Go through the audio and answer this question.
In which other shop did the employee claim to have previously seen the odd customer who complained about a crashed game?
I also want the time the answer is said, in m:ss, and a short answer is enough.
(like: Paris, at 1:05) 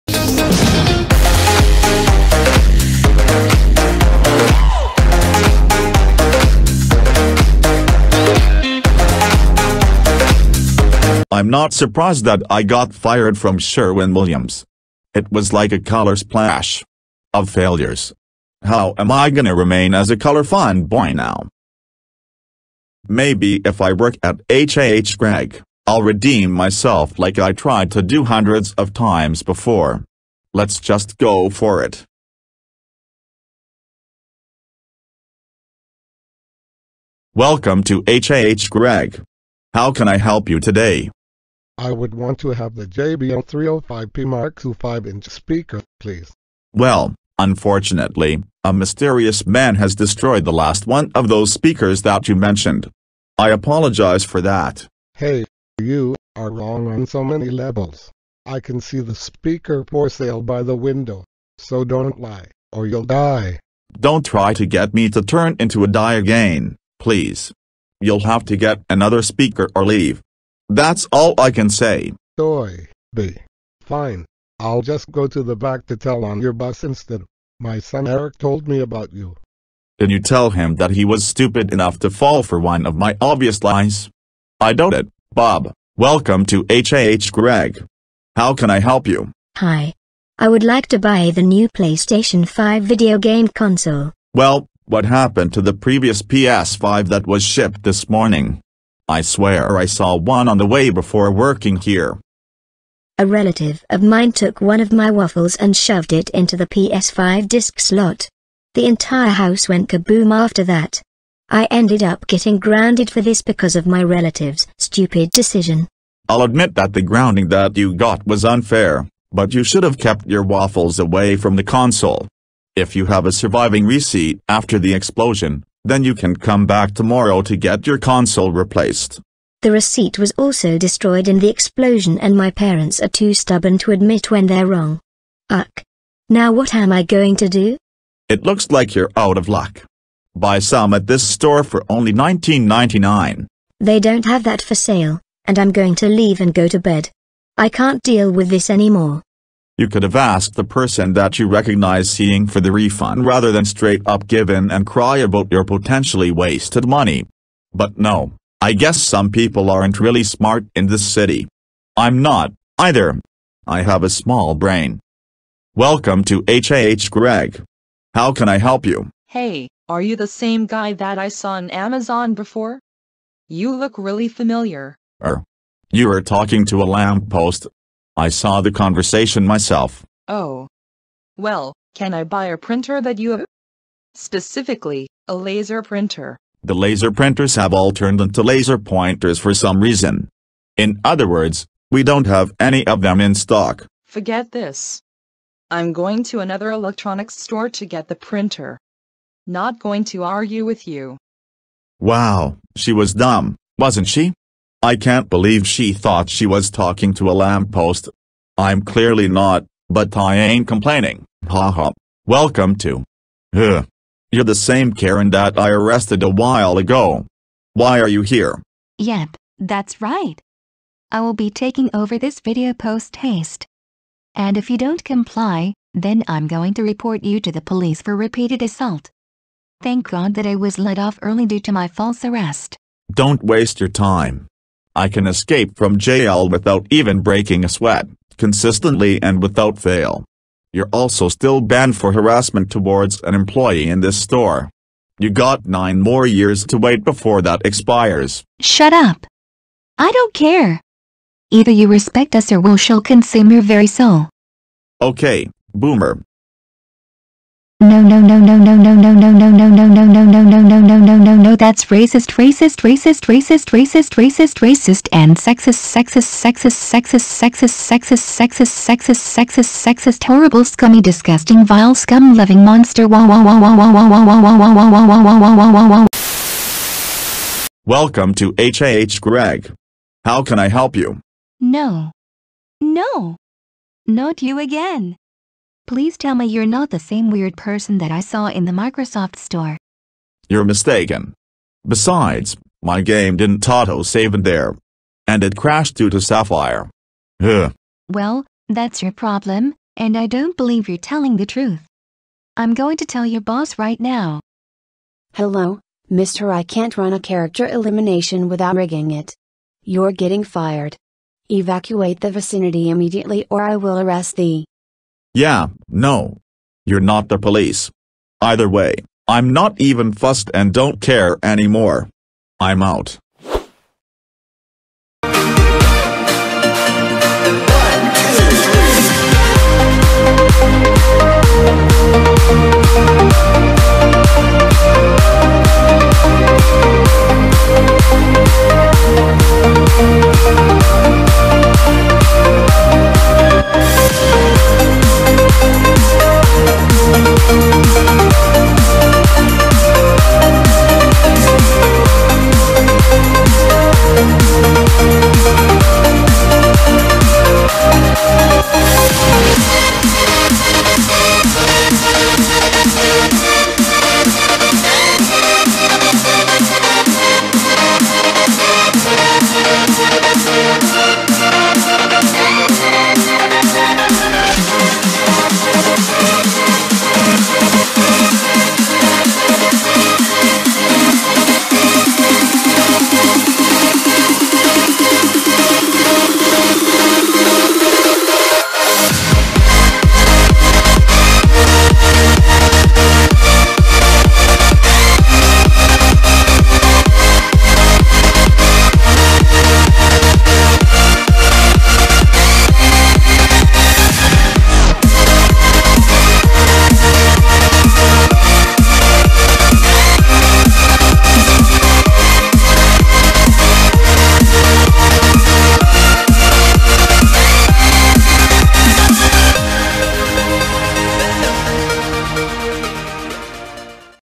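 Microsoft store, at 4:48.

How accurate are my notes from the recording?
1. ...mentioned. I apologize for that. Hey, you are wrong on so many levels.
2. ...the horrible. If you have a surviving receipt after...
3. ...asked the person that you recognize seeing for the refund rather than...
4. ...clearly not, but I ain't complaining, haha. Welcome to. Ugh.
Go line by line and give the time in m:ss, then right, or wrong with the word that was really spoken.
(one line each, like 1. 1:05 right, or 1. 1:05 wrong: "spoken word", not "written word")
1. 0:52 right
2. 2:01 wrong: "console", not "horrible"
3. 2:30 right
4. 3:28 right.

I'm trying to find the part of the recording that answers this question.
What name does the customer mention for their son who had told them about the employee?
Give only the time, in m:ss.
1:18.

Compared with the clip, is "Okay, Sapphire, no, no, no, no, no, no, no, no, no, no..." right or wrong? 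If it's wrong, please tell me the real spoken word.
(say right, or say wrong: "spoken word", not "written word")
wrong: "Boomer", not "Sapphire".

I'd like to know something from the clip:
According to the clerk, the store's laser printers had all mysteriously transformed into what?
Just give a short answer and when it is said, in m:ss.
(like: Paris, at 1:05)
laser pointers, at 3:08.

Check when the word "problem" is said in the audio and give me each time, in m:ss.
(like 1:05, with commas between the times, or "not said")
4:59.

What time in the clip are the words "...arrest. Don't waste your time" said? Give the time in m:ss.
3:52.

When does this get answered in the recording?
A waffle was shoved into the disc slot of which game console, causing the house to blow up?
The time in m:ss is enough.
1:31.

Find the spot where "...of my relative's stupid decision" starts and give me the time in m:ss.
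1:53.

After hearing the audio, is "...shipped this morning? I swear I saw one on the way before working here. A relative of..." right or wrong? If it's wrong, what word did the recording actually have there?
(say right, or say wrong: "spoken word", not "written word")
right.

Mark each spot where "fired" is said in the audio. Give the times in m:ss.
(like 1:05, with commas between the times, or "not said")
0:12, 5:10.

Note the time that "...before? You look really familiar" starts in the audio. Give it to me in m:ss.
2:52.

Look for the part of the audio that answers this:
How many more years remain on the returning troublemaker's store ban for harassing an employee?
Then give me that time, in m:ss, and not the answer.
4:05.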